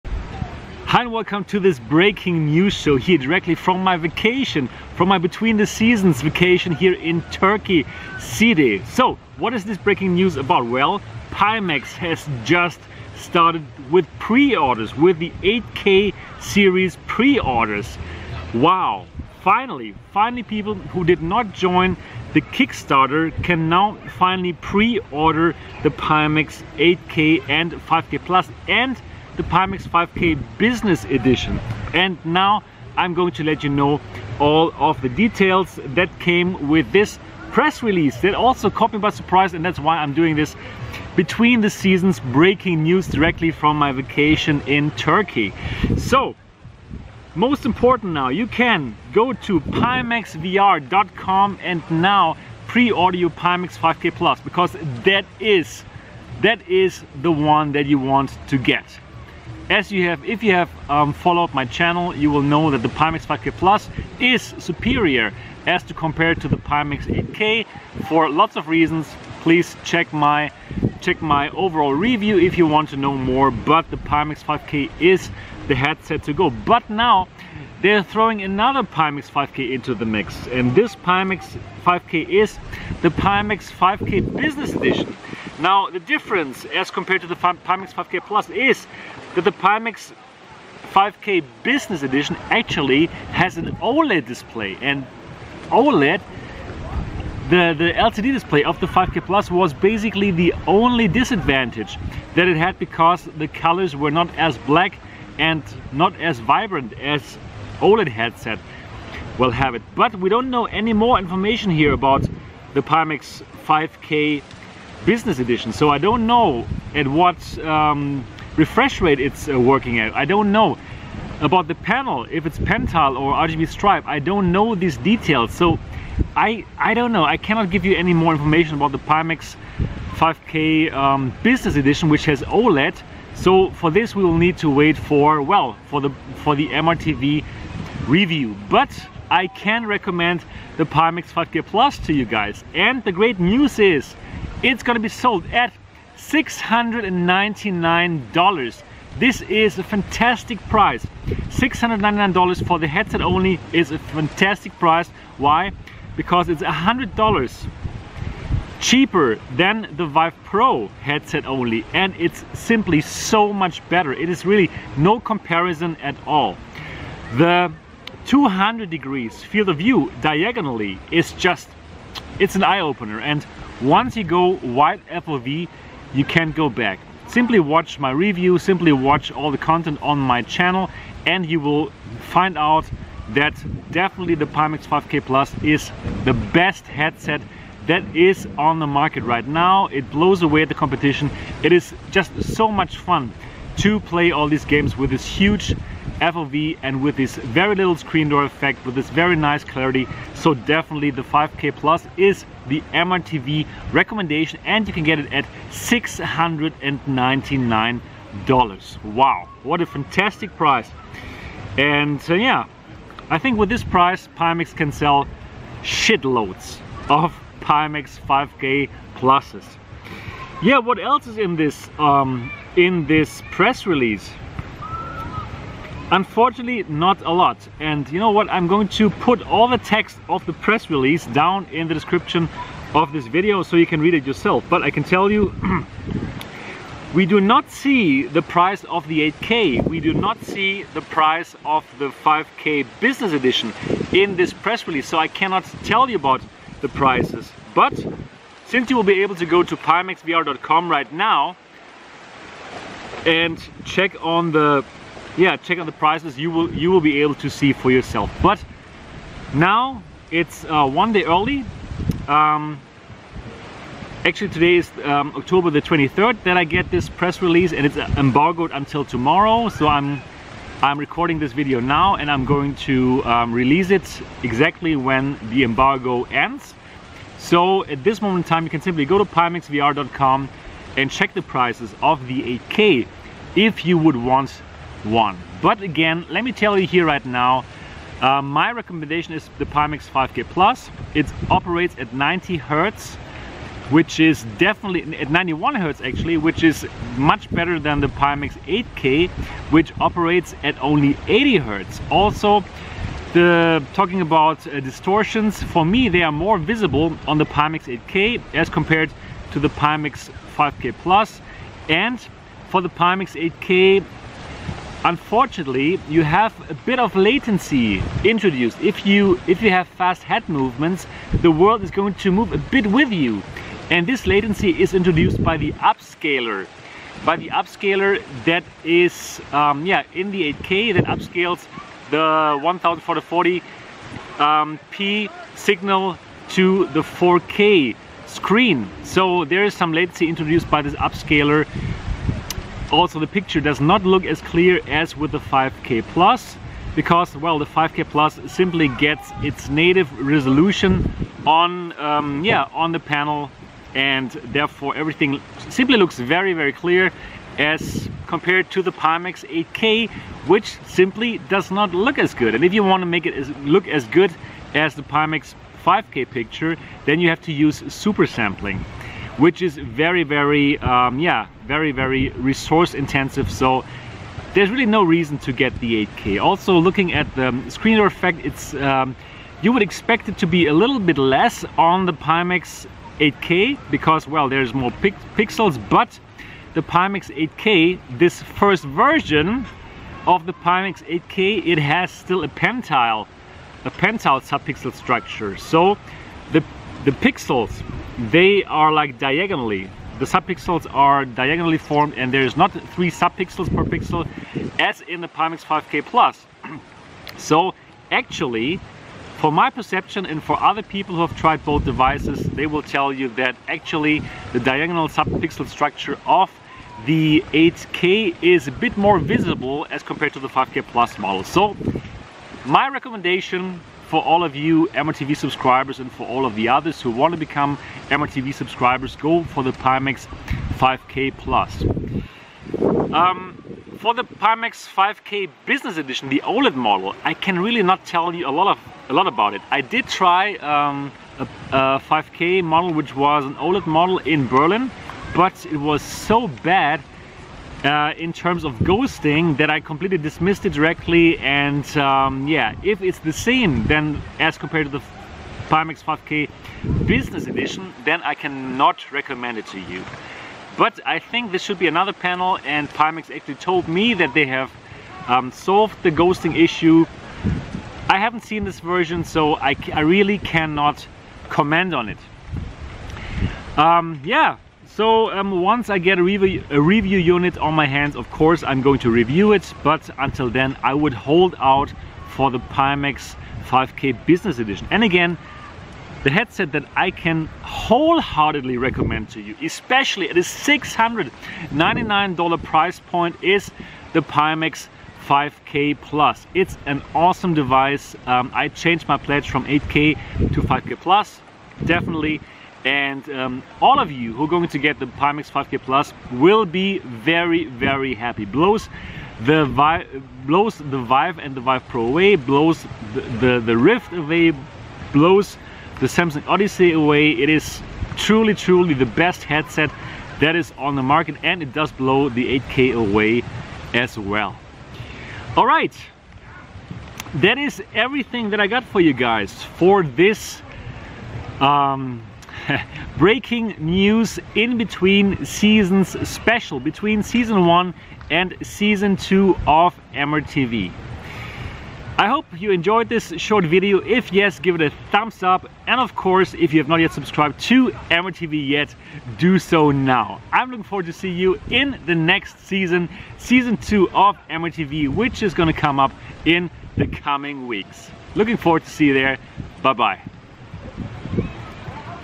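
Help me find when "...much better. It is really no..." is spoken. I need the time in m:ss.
2:43.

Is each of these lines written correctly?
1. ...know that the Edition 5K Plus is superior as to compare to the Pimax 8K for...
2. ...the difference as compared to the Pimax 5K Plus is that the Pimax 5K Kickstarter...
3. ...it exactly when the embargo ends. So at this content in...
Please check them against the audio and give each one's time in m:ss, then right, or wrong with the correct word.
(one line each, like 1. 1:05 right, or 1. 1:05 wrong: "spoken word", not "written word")
1. 1:02 wrong: "Pimax", not "Edition"
2. 1:25 wrong: "Business", not "Kickstarter"
3. 4:33 wrong: "moment", not "content".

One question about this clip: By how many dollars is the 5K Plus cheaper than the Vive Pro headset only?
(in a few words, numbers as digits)
$100.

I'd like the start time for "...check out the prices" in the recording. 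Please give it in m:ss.
4:15.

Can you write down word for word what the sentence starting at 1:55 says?
So I don't know at what um, refresh rate it's uh, working at.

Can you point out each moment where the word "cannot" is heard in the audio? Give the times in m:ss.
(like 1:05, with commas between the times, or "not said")
2:07, 4:05, 7:38, 7:50.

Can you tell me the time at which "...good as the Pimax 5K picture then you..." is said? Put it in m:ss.
6:04.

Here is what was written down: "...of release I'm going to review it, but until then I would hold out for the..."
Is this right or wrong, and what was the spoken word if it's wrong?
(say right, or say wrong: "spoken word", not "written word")
wrong: "course", not "release".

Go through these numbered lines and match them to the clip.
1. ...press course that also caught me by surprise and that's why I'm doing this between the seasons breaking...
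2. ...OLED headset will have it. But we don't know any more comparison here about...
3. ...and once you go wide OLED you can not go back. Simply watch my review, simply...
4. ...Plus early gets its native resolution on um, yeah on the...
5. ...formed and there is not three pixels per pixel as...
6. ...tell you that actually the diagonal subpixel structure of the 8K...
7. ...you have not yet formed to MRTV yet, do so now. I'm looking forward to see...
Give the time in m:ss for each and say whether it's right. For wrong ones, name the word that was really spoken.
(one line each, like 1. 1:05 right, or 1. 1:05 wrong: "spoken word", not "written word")
1. 0:37 wrong: "release", not "course"
2. 1:47 wrong: "information", not "comparison"
3. 2:53 wrong: "FOV", not "OLED"
4. 5:48 wrong: "simply", not "early"
5. 6:41 wrong: "subpixels", not "pixels"
6. 6:52 right
7. 9:06 wrong: "subscribed", not "formed".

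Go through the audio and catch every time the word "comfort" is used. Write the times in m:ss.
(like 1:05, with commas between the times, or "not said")
not said.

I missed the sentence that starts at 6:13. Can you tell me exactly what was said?
So there's really no reason to get the 8K.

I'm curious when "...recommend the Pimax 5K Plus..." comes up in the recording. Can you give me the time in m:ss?
2:19.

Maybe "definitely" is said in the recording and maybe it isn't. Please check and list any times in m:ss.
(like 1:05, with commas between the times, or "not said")
3:03, 3:20, 4:54, 8:21.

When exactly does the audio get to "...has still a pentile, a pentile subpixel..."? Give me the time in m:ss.
6:31.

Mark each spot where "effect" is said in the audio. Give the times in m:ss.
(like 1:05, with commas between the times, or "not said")
3:18, 6:18.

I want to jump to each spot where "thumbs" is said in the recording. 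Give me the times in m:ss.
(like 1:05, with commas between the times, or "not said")
9:05.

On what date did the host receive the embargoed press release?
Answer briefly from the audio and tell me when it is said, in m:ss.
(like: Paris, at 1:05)
October 23, at 4:25.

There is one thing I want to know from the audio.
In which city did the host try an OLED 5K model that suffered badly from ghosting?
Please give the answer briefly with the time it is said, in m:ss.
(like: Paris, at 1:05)
Berlin, at 7:24.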